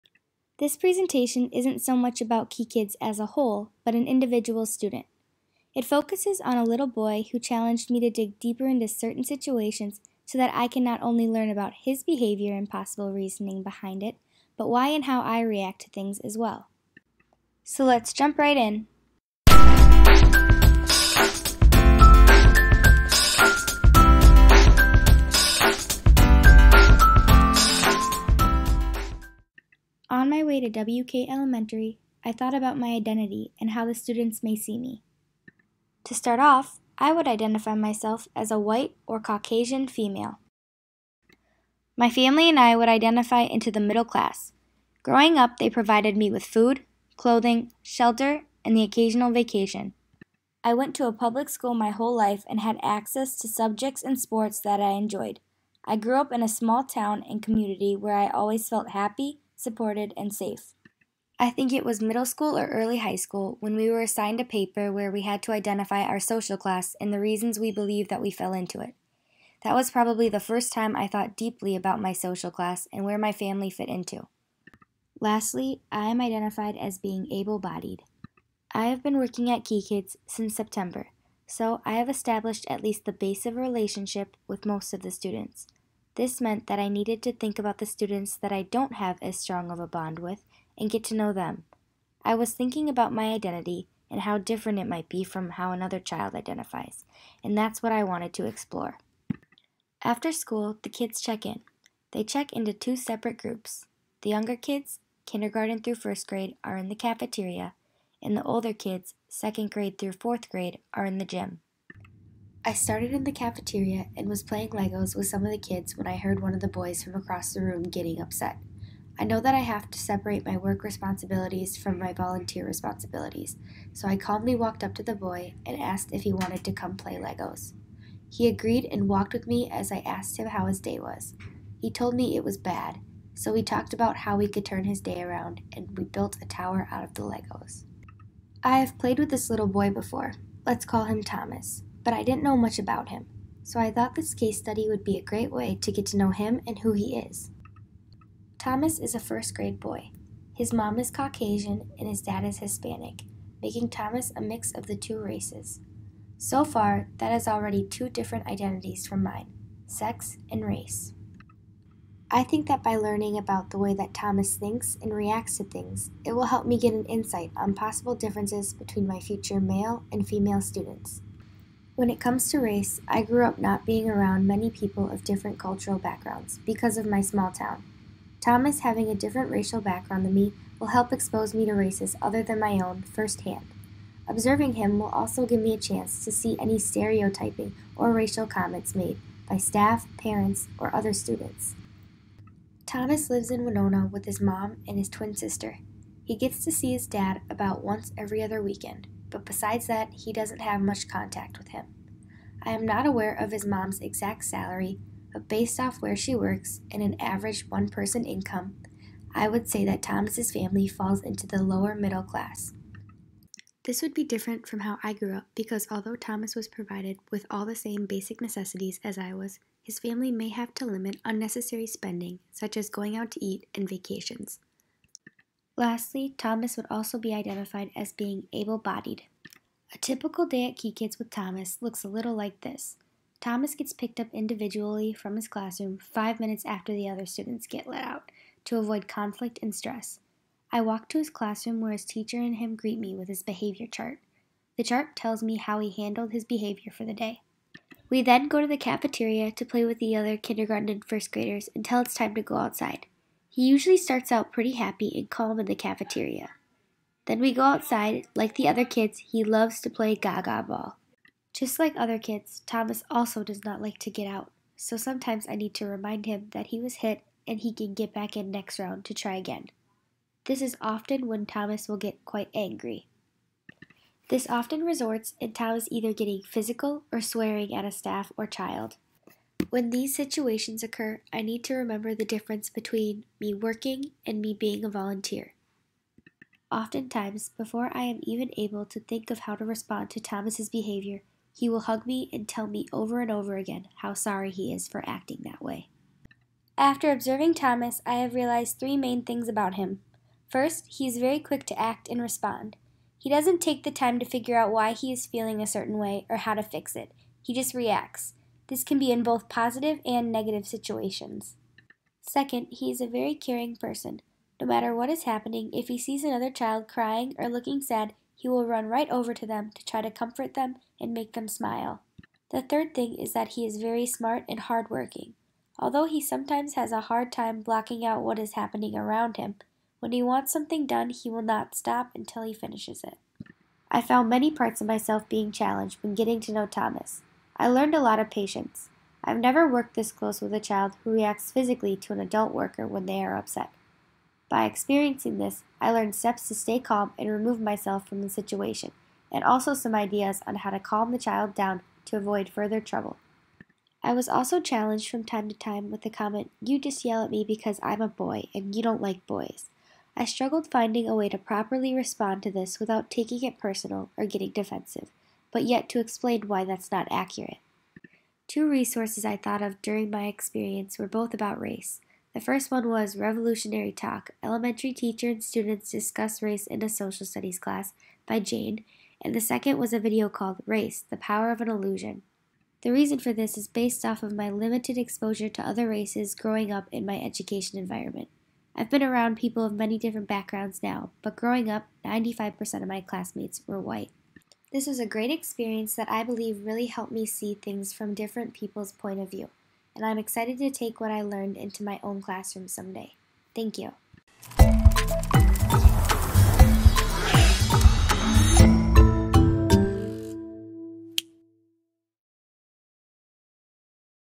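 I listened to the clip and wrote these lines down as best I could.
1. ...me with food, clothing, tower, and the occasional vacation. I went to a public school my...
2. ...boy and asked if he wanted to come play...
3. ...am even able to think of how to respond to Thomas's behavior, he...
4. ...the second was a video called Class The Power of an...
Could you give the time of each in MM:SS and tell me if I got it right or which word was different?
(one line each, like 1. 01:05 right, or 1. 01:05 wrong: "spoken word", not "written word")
1. 00:46 wrong: "shelter", not "tower"
2. 02:05 right
3. 04:48 right
4. 06:19 wrong: "Race", not "Class".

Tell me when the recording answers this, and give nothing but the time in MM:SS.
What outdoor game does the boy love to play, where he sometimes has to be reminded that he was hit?
04:20.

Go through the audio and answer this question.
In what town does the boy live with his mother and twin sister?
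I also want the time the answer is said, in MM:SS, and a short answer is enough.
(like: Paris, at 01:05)
Winona, at 03:13.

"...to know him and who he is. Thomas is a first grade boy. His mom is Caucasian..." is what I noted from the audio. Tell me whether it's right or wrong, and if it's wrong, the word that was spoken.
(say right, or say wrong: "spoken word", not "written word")
right.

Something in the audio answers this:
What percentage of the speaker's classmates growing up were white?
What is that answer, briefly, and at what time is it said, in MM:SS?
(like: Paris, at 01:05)
95%, at 06:32.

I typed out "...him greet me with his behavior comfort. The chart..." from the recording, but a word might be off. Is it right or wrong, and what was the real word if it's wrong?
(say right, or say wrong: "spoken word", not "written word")
wrong: "chart", not "comfort".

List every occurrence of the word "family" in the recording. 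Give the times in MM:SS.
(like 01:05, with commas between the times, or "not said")
00:42, 01:13, 03:30, 03:39.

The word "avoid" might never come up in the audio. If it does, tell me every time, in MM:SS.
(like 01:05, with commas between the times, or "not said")
03:58, 05:52.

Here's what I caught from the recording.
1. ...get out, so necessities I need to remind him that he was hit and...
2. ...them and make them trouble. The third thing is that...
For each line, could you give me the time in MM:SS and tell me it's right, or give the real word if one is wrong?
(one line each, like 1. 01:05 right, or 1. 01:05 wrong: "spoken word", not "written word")
1. 04:24 wrong: "sometimes", not "necessities"
2. 05:20 wrong: "smile", not "trouble".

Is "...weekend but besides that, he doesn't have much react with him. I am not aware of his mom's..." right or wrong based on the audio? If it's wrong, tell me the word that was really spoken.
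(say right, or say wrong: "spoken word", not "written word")
wrong: "contact", not "react".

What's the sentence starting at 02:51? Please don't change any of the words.
When it comes to race, I grew up not being around many people of different cultural backgrounds because of my small town.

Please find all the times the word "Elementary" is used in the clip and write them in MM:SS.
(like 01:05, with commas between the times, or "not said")
00:31, 06:14.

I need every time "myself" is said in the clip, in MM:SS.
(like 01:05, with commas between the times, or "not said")
00:37, 05:34, 05:47.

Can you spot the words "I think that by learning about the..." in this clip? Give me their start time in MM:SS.
02:42.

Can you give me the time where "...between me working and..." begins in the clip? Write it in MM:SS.
04:42.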